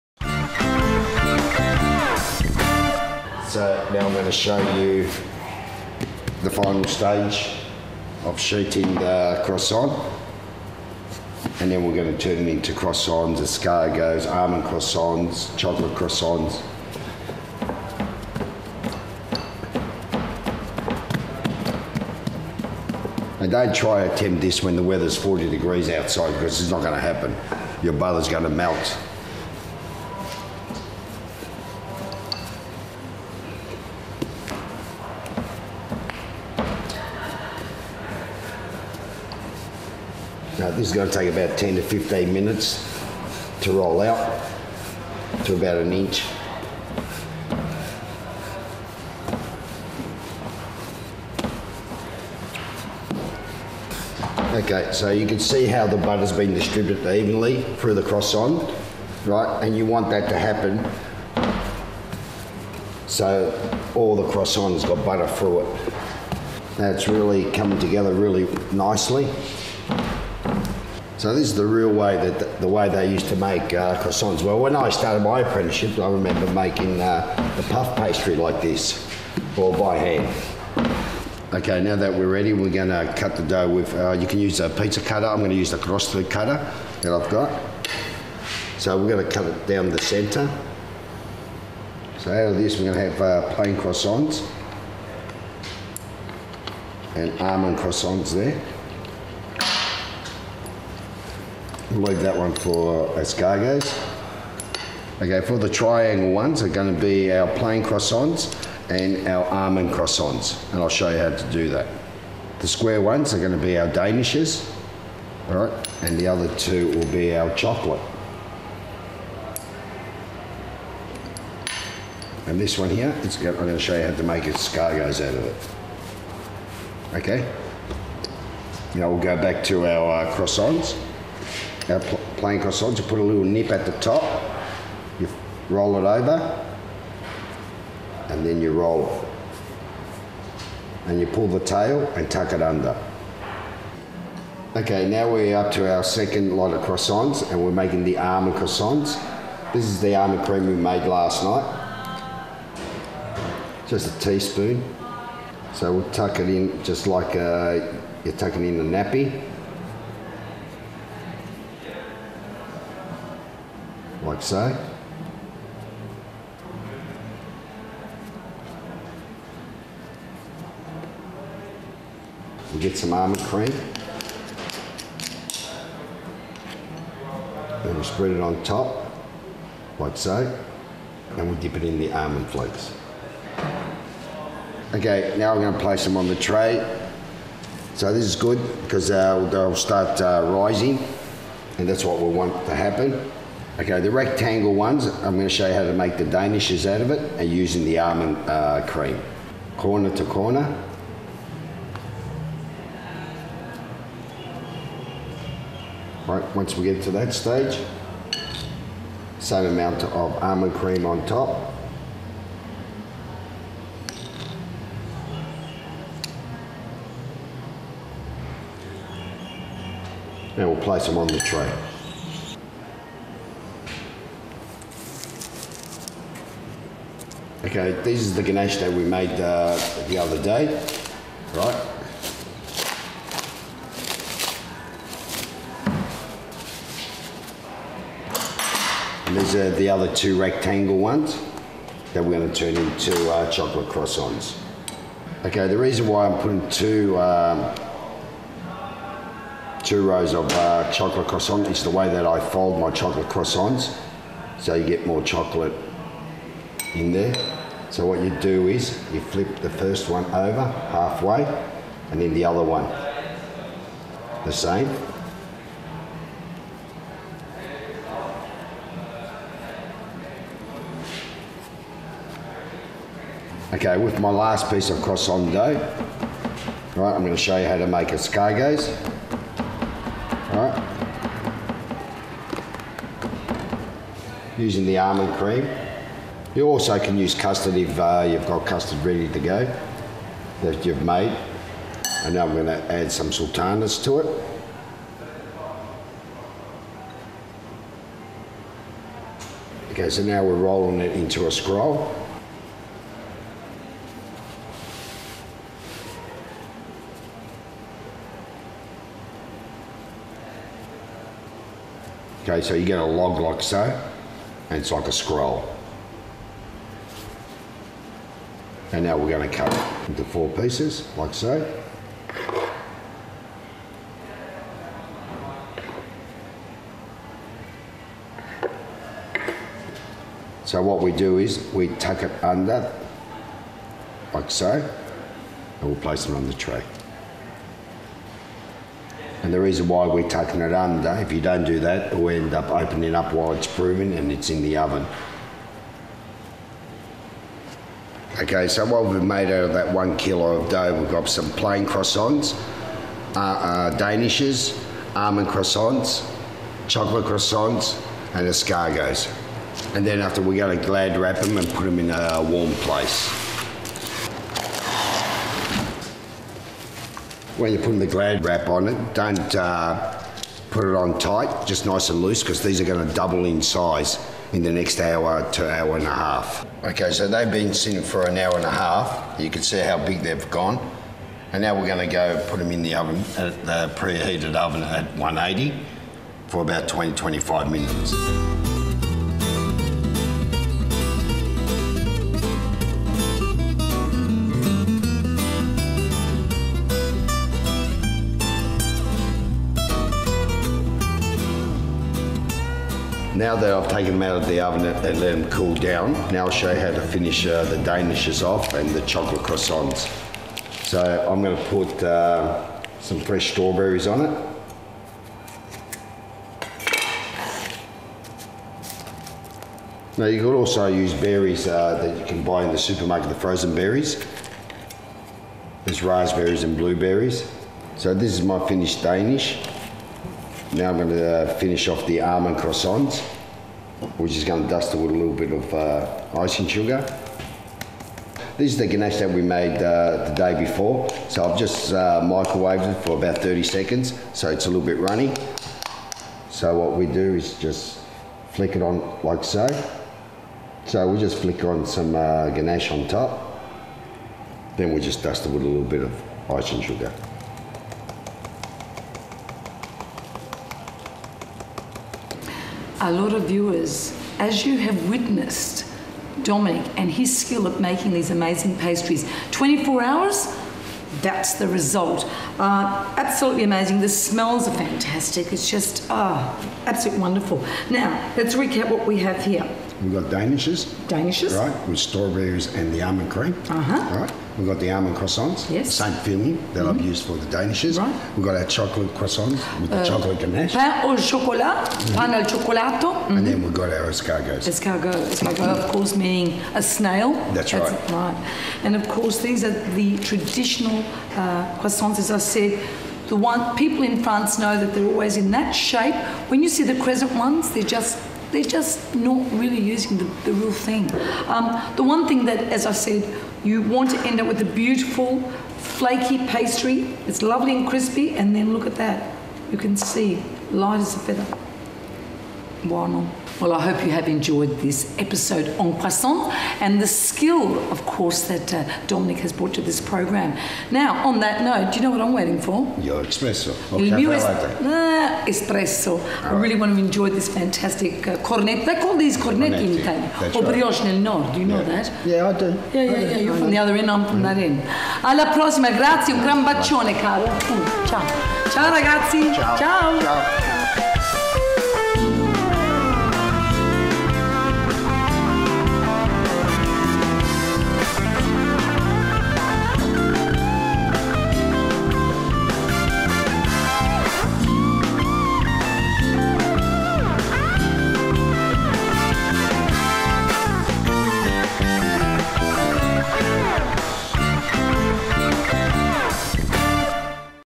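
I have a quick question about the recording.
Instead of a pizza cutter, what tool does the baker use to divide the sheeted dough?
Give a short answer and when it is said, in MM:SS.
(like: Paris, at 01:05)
cross cutter, at 01:25.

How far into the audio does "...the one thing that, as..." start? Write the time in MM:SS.
08:31.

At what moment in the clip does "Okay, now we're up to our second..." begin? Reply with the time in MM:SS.
02:24.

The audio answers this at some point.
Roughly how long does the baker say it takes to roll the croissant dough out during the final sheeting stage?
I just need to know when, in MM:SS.
00:41.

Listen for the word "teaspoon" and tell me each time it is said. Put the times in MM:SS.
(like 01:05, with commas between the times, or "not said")
02:34.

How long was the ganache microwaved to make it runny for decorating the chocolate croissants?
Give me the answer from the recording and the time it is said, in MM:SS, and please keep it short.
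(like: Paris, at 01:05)
30 seconds, at 07:23.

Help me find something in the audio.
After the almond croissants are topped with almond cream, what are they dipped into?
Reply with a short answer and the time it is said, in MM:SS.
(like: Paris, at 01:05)
almond flakes, at 03:02.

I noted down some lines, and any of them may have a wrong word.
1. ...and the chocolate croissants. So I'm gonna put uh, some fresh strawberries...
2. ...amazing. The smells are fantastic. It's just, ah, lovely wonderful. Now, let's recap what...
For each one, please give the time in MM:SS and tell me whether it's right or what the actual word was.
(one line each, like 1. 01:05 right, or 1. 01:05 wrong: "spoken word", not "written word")
1. 06:48 right
2. 07:53 wrong: "absolutely", not "lovely".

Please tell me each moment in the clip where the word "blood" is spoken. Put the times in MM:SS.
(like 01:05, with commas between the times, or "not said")
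not said.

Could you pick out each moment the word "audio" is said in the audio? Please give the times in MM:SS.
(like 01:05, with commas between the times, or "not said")
not said.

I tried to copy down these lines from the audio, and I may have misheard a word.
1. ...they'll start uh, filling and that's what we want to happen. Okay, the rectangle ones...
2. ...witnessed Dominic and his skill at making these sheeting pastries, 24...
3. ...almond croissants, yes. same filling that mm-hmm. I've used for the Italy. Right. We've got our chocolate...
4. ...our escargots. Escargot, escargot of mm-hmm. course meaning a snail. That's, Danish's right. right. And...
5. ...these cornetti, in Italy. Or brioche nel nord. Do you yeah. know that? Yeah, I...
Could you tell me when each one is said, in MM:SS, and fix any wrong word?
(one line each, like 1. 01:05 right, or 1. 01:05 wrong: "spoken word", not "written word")
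1. 03:09 wrong: "rising", not "filling"
2. 07:45 wrong: "amazing", not "sheeting"
3. 08:04 wrong: "Danishes", not "Italy"
4. 08:13 wrong: "That", not "Danish"
5. 08:59 right.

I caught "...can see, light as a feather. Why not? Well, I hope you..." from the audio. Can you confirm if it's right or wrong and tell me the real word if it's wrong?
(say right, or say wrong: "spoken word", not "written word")
right.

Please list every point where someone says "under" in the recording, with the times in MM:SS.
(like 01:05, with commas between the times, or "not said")
02:22, 05:32, 05:40.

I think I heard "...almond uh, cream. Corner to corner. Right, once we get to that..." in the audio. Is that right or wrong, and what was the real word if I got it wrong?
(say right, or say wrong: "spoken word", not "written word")
right.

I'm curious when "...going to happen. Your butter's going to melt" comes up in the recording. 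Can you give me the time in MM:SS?
00:26.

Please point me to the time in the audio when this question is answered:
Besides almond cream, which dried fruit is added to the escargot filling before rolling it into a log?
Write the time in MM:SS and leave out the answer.
04:53.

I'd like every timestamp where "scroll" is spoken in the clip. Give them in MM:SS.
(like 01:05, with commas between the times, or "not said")
05:01, 05:15.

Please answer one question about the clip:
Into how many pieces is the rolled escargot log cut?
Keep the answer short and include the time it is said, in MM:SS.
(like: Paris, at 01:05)
4, at 05:20.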